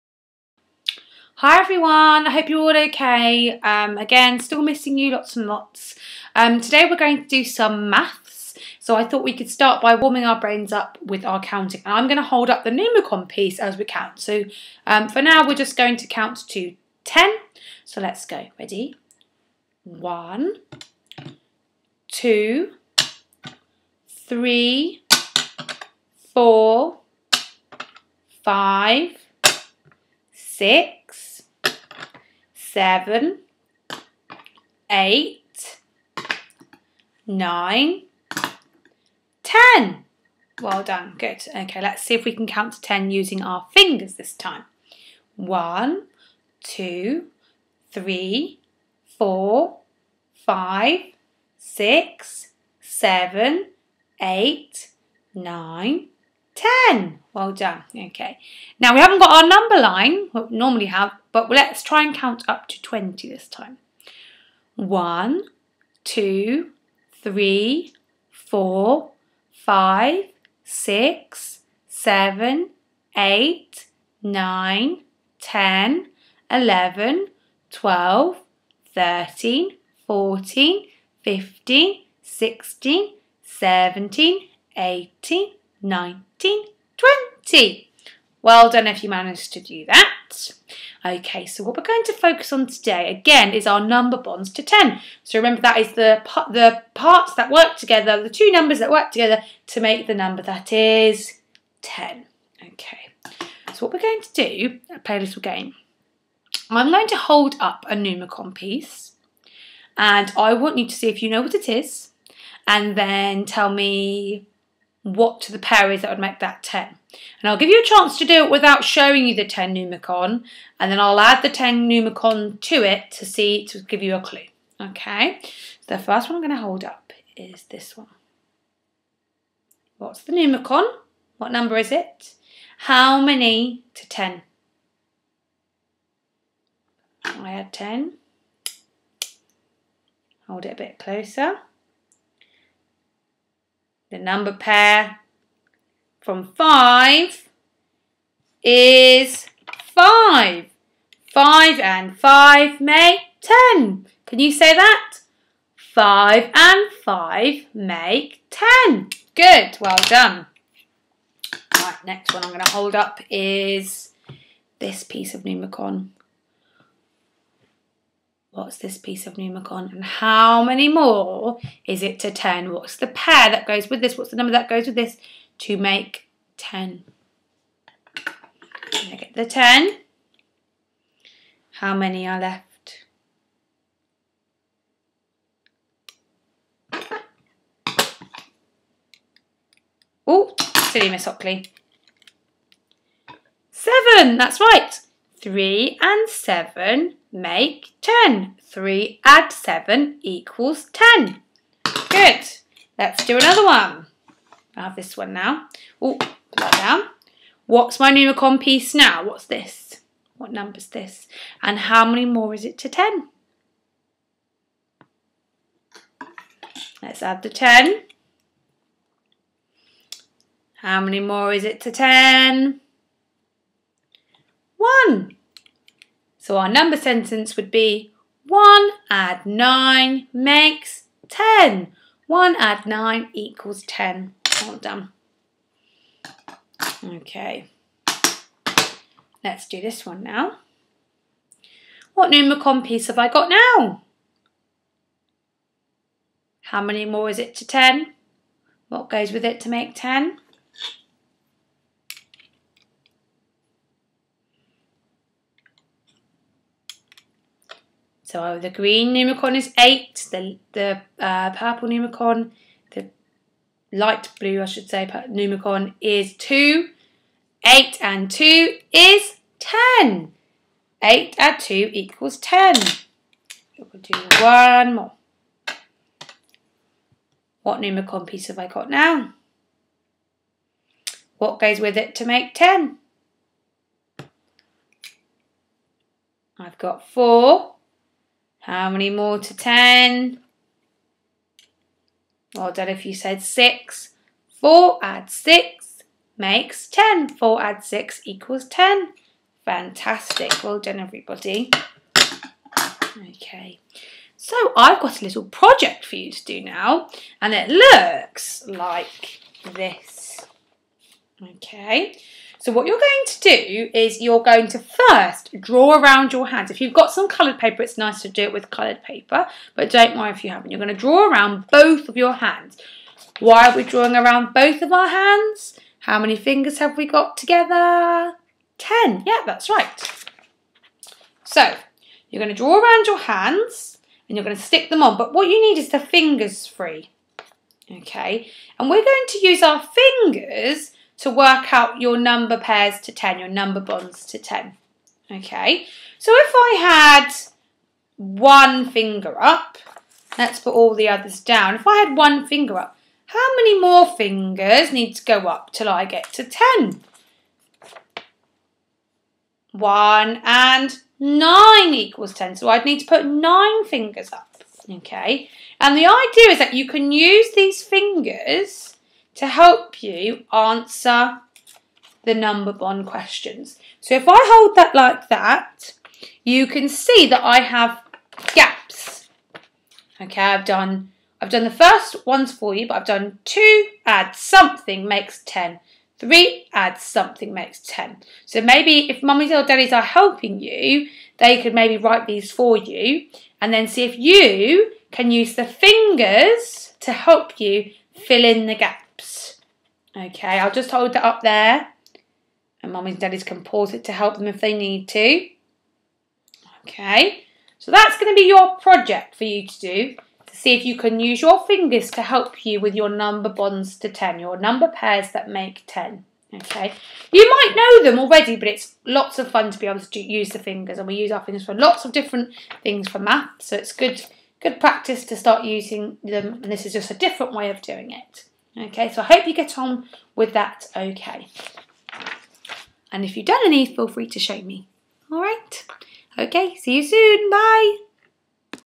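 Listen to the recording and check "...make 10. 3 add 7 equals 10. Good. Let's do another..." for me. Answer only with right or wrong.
right.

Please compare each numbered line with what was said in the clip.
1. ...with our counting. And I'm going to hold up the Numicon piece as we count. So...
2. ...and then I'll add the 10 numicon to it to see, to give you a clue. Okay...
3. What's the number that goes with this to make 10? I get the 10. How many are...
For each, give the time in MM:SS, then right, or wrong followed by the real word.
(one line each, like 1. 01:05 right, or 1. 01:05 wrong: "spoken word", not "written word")
1. 00:11 right
2. 02:00 right
3. 02:54 right.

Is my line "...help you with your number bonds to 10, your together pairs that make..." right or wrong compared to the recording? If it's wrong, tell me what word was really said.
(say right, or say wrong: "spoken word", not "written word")
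wrong: "number", not "together".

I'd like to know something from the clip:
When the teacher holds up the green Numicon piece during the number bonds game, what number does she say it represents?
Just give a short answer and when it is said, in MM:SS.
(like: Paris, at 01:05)
8, at 04:18.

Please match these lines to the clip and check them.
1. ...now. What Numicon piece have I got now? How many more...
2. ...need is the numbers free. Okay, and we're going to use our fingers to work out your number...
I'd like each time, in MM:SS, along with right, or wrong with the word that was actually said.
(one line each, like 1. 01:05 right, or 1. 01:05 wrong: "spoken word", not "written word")
1. 04:00 right
2. 05:35 wrong: "fingers", not "numbers".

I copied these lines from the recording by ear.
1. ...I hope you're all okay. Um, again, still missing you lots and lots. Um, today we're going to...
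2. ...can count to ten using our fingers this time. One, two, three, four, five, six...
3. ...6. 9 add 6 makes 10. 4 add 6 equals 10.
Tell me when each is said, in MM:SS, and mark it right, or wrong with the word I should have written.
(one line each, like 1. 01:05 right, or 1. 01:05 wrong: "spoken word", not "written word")
1. 00:02 right
2. 00:42 right
3. 04:53 wrong: "4", not "9".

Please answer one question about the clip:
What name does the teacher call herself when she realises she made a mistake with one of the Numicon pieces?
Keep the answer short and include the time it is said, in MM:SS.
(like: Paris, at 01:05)
Miss Hockley, at 03:10.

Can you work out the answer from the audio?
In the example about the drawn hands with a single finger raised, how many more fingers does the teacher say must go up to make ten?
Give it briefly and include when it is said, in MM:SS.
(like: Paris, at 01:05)
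9, at 06:02.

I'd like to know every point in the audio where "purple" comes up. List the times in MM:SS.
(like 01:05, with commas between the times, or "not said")
04:21.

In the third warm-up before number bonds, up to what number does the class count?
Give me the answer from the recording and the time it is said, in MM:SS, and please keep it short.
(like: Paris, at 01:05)
20, at 01:02.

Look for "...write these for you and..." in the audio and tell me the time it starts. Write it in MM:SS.
06:31.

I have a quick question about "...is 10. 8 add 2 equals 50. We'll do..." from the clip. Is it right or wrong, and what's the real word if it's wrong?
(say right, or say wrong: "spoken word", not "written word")
wrong: "10", not "50".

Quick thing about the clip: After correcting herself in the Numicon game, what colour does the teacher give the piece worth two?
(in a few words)
light blue.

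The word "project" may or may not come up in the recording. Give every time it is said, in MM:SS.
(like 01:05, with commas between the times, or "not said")
05:05, 06:48.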